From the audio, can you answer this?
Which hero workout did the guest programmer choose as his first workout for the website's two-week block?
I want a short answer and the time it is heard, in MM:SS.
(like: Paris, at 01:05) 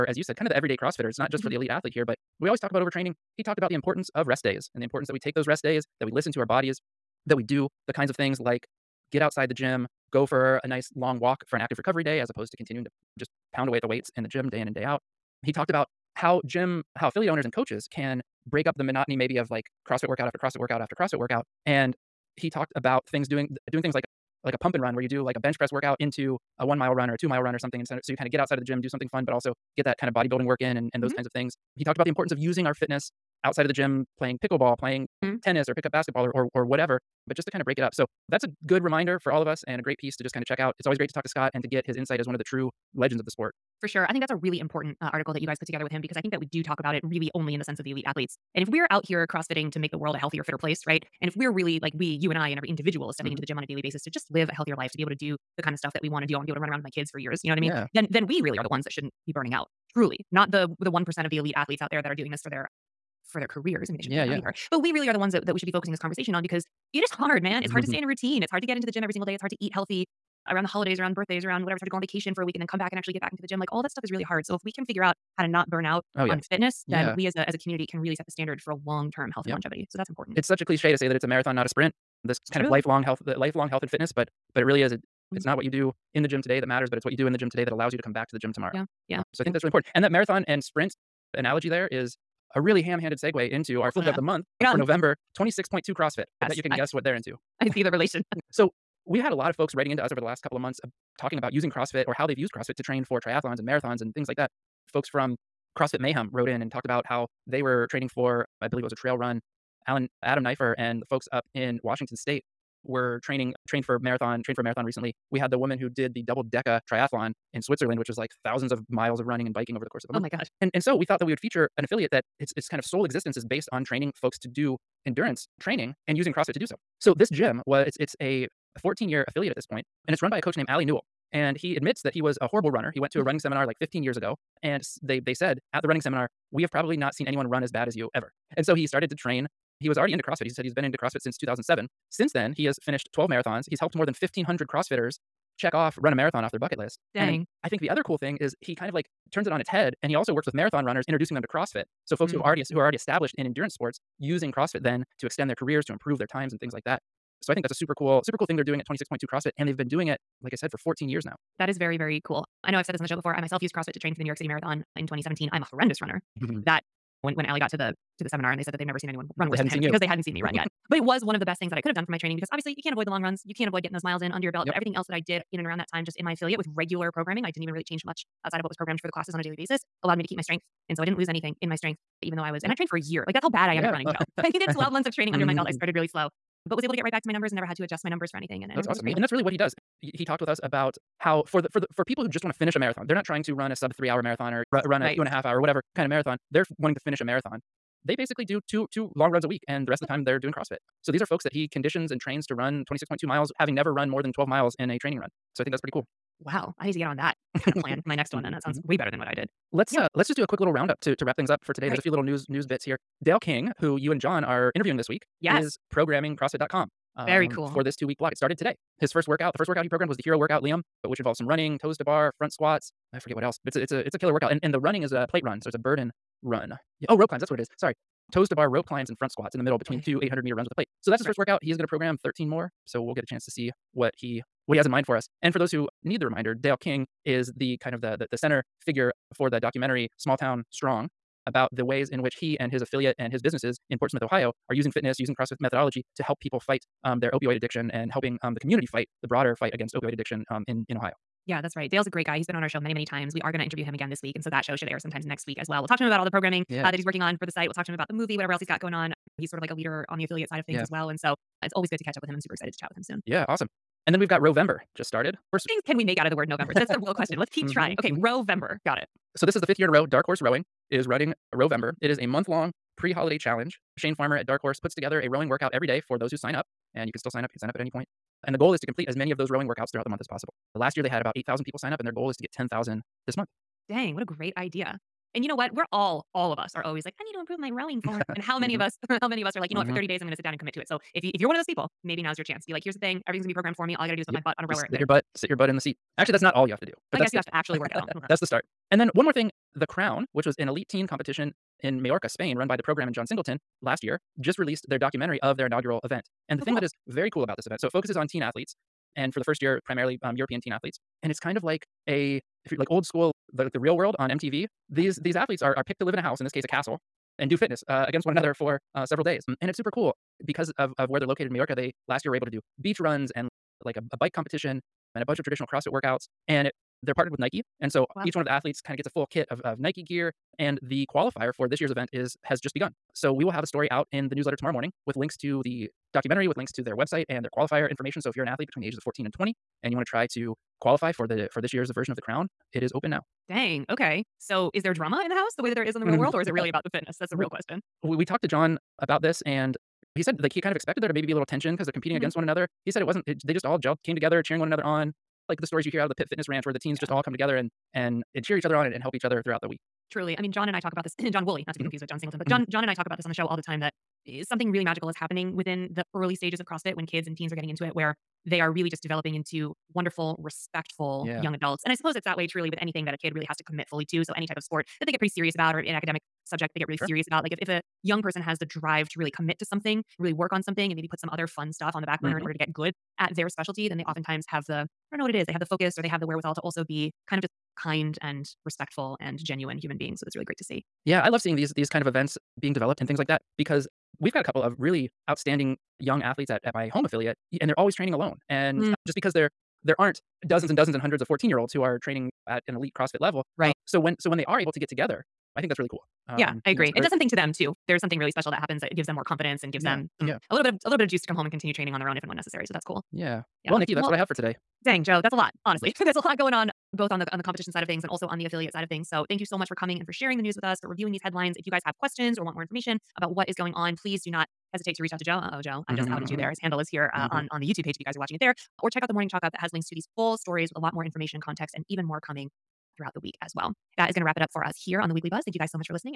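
Liam, at 03:40.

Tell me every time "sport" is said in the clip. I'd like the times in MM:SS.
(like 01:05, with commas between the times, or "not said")
00:43, 02:33, 06:14.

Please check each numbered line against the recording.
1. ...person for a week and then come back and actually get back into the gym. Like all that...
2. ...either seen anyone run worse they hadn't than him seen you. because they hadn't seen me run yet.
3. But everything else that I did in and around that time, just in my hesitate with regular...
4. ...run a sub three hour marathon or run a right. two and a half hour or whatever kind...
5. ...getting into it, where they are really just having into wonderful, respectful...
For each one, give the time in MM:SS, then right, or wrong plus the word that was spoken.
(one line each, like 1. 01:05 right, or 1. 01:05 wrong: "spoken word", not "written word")
1. 01:12 wrong: "vacation", not "person"
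2. 02:48 wrong: "never", not "either"
3. 02:54 wrong: "affiliate", not "hesitate"
4. 03:13 right
5. 06:07 wrong: "developing", not "having".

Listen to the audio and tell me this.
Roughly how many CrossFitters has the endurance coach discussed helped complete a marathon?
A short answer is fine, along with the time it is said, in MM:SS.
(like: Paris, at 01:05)
1,500, at 02:24.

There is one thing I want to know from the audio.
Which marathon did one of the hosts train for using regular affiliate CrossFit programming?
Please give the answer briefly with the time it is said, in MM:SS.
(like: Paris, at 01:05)
New York City Marathon, at 02:44.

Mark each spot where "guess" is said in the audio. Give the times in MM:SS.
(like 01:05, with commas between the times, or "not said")
01:36, 04:57.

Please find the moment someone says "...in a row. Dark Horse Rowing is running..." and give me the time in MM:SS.
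04:29.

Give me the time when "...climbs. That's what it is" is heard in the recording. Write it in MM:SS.
03:47.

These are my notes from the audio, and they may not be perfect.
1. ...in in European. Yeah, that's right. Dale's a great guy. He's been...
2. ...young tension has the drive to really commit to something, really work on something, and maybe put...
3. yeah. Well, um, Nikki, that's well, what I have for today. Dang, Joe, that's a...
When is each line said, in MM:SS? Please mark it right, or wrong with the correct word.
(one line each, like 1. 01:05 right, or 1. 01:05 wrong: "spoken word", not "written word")
1. 04:10 wrong: "Ohio", not "European"
2. 06:18 wrong: "person", not "tension"
3. 06:53 right.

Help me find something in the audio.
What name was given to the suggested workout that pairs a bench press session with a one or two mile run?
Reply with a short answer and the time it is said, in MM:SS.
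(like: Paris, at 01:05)
pump and run, at 00:24.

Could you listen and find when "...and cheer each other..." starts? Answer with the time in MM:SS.
05:58.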